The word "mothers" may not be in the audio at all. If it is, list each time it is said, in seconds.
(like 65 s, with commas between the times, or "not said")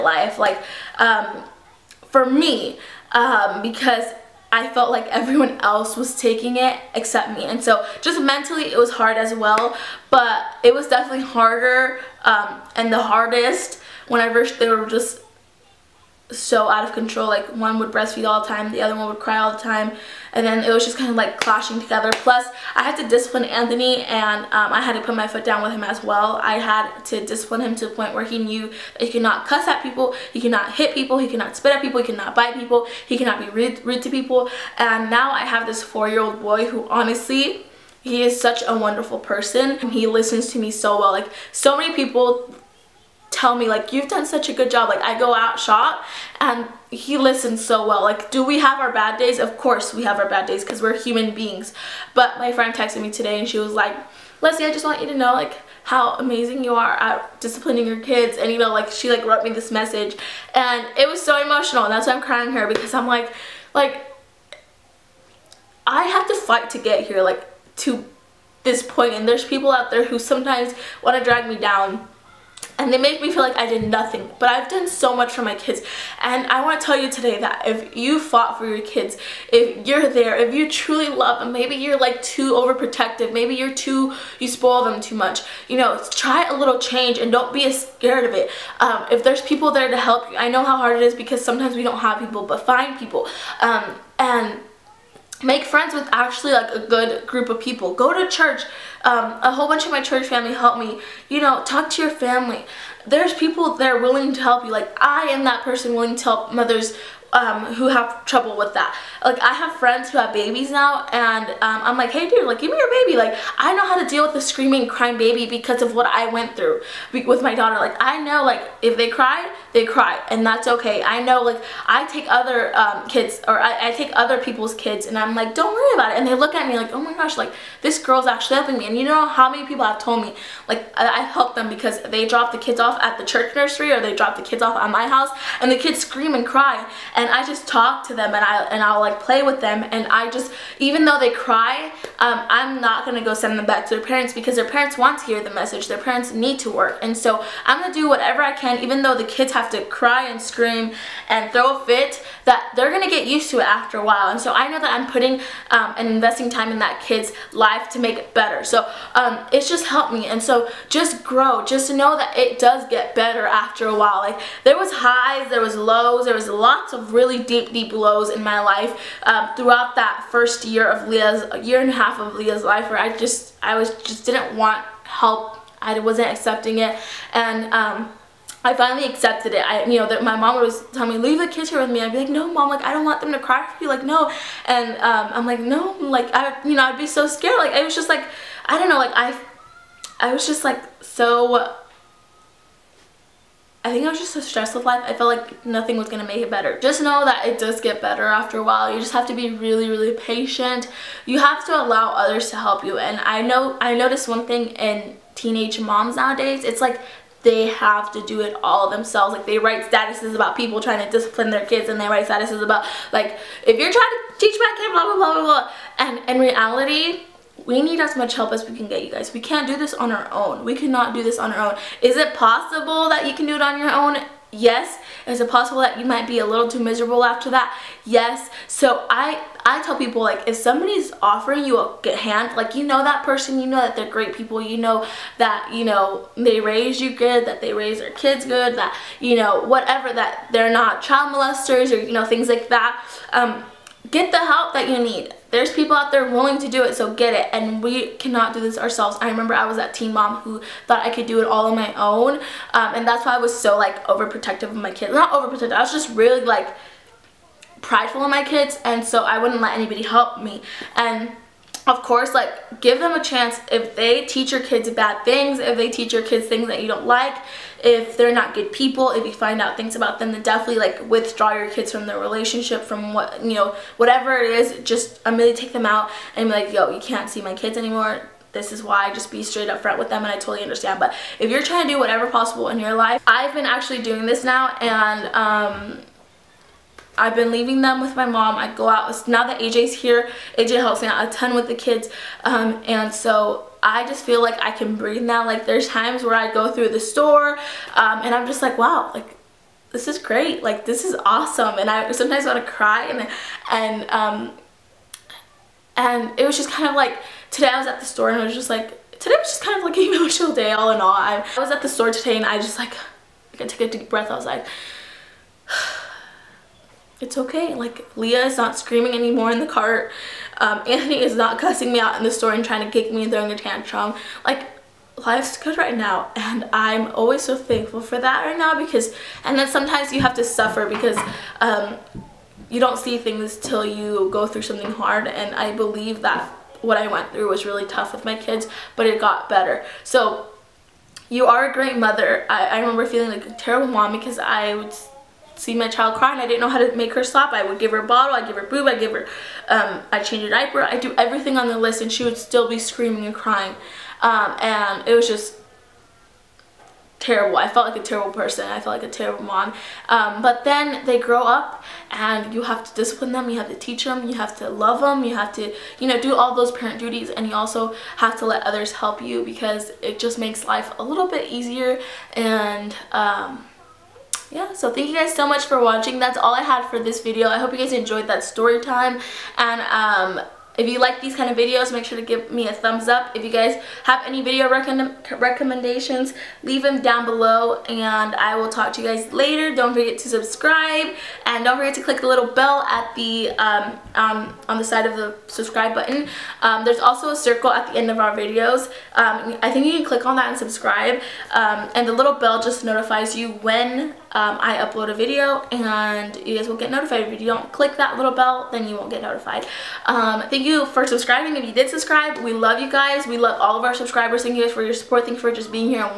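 106 s, 341 s.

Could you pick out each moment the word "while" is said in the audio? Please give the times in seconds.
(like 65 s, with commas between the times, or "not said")
154 s, 163 s, 198 s.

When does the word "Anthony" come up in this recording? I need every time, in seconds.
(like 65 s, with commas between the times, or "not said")
23 s, 320 s.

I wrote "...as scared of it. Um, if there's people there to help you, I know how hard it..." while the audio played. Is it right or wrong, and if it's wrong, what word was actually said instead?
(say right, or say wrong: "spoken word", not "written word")
right.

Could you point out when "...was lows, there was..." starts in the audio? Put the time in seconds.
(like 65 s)
165 s.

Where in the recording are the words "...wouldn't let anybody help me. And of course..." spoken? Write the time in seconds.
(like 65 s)
259 s.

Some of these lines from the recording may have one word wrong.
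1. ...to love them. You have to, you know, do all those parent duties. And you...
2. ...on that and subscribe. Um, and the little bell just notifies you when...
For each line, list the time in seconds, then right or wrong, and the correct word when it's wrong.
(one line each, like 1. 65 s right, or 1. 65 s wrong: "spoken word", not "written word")
1. 364 s right
2. 400 s right.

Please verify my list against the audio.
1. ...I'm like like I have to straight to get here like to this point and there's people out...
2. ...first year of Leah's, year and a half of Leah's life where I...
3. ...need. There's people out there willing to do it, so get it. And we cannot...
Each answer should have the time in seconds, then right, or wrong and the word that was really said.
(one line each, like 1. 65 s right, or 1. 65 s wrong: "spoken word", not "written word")
1. 62 s wrong: "fight", not "straight"
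2. 170 s right
3. 244 s right.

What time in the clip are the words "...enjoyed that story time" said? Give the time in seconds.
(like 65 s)
377 s.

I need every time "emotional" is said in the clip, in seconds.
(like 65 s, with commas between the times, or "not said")
61 s, 310 s.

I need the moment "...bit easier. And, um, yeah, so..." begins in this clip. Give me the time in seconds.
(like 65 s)
371 s.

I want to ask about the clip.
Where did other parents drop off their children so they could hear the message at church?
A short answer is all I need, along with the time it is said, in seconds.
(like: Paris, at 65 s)
church nursery, at 133 s.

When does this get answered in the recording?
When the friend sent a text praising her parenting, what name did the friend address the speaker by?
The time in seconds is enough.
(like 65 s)
54 s.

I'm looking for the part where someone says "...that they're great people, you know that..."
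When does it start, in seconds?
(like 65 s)
233 s.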